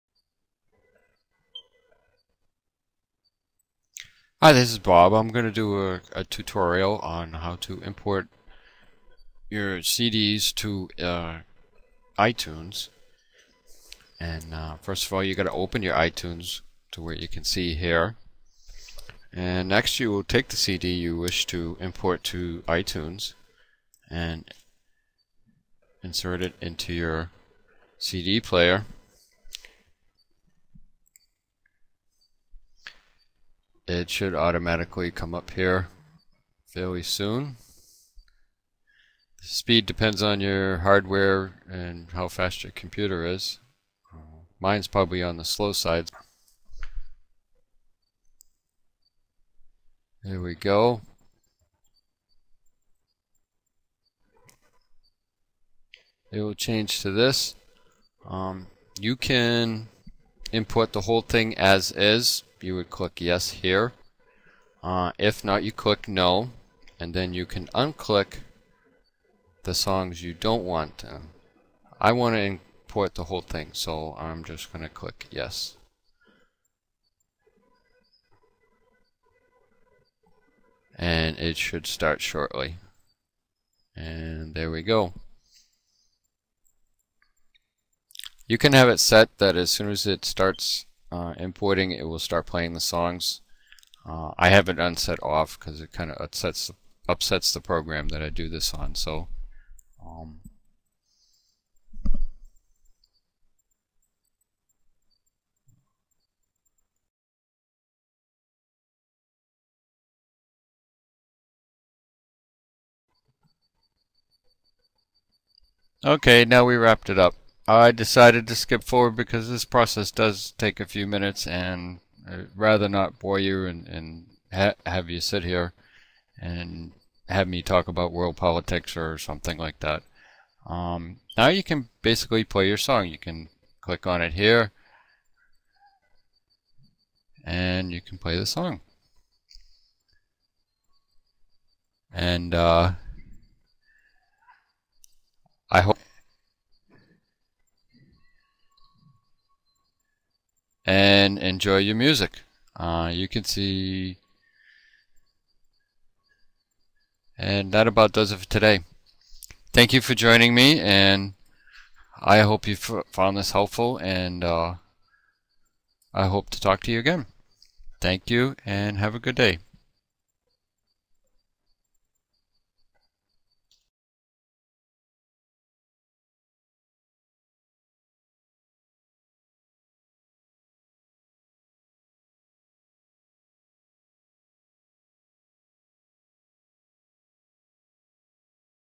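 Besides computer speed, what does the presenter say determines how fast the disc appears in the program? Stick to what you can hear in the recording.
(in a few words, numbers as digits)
your hardware.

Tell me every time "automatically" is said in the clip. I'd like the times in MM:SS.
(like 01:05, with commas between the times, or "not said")
00:34.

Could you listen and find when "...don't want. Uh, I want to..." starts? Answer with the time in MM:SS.
01:10.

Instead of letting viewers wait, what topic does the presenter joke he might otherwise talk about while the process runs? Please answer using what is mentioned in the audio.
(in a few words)
world politics.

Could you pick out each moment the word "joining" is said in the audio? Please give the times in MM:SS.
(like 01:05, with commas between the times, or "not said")
02:40.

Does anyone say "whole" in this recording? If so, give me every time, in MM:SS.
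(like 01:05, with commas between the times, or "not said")
01:01, 01:13.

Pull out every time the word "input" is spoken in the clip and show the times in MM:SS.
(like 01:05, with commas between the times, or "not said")
01:00.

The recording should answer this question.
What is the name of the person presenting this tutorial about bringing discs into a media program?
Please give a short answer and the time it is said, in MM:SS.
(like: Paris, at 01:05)
Bob, at 00:04.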